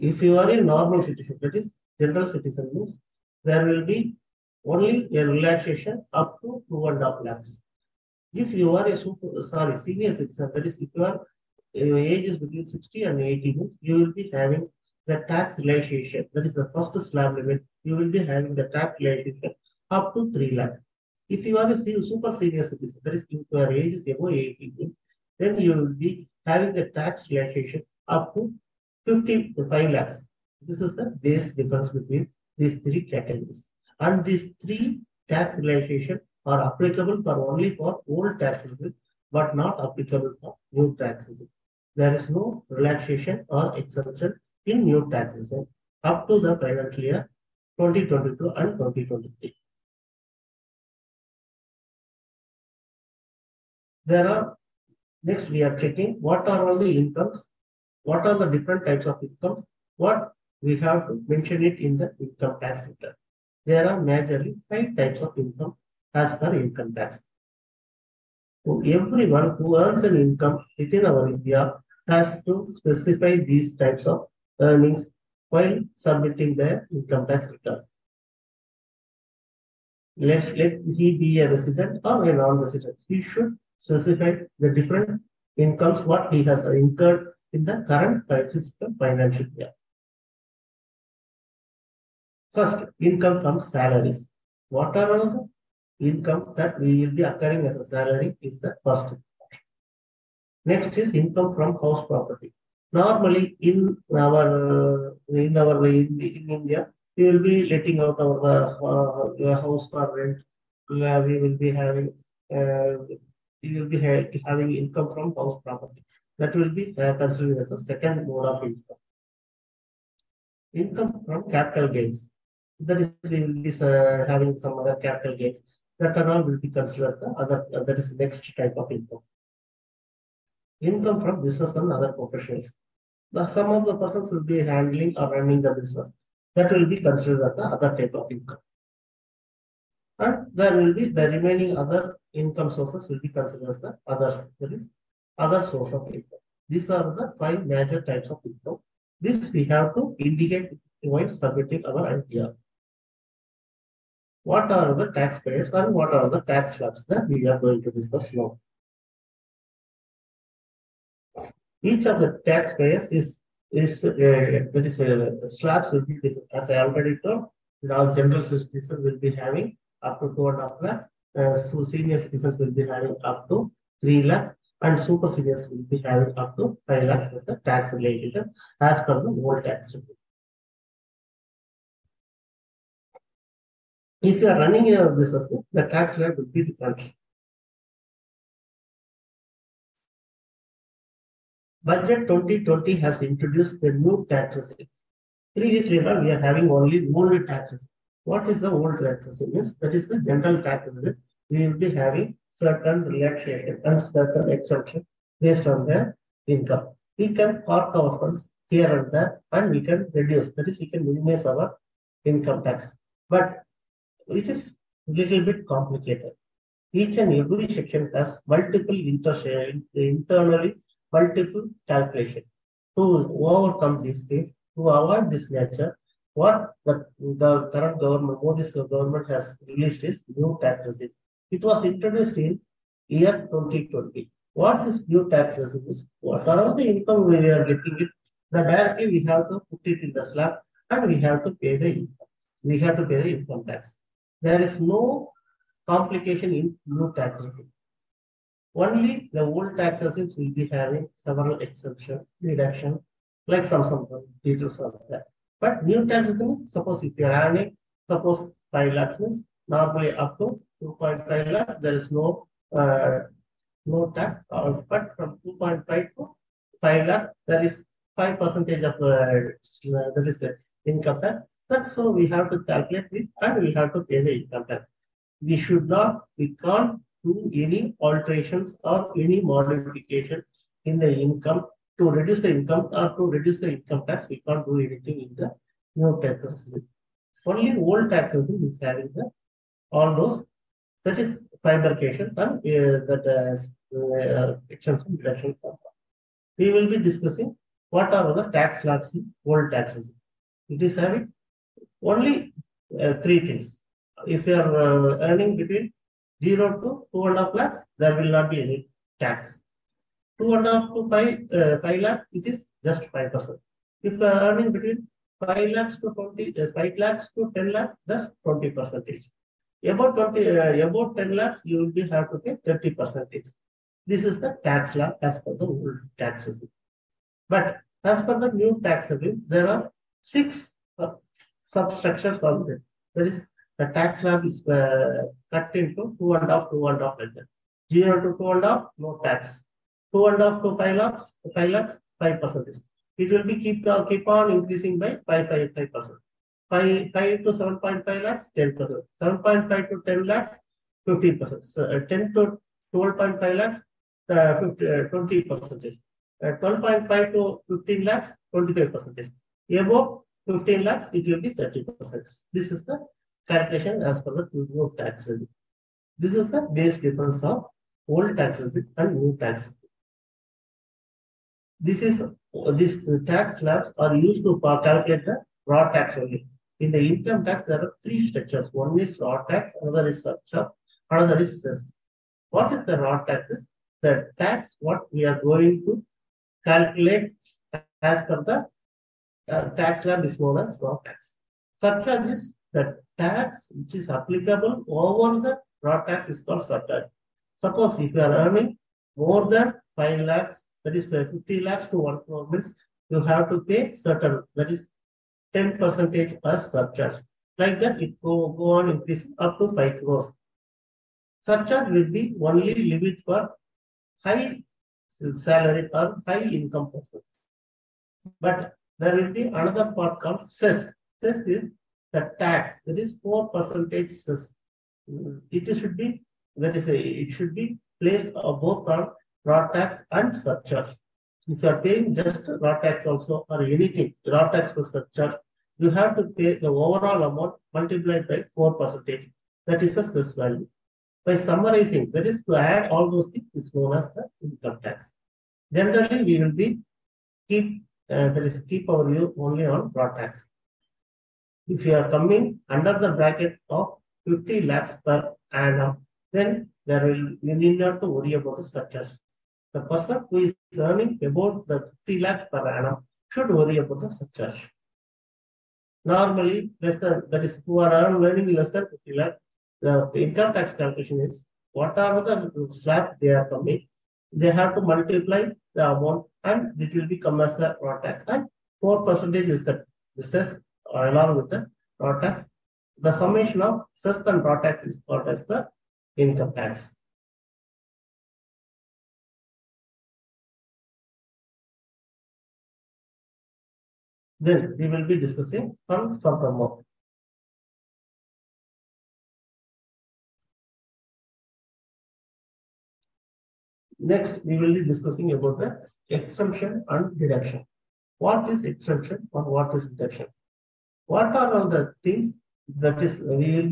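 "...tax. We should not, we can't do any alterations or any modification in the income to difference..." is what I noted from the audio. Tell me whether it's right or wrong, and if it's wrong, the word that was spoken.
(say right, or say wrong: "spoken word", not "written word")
wrong: "reduce", not "difference".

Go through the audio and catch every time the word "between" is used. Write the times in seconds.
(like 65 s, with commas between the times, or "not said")
12 s, 31 s, 305 s, 314 s.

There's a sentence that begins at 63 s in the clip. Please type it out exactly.
There are majorly five types of income as per income tax.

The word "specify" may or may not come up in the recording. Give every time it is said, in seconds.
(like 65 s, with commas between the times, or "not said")
72 s, 83 s.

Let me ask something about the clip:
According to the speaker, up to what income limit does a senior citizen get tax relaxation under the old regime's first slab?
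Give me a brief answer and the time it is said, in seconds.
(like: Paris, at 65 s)
3 lakhs, at 19 s.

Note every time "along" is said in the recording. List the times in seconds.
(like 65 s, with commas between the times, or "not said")
481 s.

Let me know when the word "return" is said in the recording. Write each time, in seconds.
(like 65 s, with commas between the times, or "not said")
62 s, 77 s.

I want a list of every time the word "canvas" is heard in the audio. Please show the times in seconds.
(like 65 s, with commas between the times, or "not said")
not said.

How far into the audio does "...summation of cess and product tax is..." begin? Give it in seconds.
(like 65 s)
483 s.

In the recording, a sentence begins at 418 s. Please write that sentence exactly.
But there will be another part called cess.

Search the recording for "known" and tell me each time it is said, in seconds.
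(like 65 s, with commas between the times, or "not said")
390 s, 443 s.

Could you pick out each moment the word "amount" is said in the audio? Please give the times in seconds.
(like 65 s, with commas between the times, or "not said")
437 s, 475 s, 496 s.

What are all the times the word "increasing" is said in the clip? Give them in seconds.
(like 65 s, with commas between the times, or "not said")
344 s, 408 s.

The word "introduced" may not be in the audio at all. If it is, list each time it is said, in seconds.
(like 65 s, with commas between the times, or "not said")
193 s, 231 s.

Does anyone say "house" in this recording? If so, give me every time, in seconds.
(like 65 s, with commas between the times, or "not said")
101 s, 109 s, 115 s.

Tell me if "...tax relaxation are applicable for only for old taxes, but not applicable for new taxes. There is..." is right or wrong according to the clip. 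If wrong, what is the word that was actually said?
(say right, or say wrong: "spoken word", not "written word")
right.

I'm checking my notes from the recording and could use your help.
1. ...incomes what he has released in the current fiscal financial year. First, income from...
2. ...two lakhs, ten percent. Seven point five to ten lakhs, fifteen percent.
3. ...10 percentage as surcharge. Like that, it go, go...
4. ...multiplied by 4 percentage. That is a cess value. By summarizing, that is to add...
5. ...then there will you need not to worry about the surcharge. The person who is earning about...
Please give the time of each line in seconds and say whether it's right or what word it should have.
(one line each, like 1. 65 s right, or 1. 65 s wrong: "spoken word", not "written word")
1. 85 s wrong: "incurred", not "released"
2. 348 s wrong: "five", not "two"
3. 405 s right
4. 437 s right
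5. 456 s right.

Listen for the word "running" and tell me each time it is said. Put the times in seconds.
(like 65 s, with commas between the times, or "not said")
135 s, 184 s.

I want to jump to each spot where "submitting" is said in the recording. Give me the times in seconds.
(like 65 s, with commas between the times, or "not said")
75 s, 151 s.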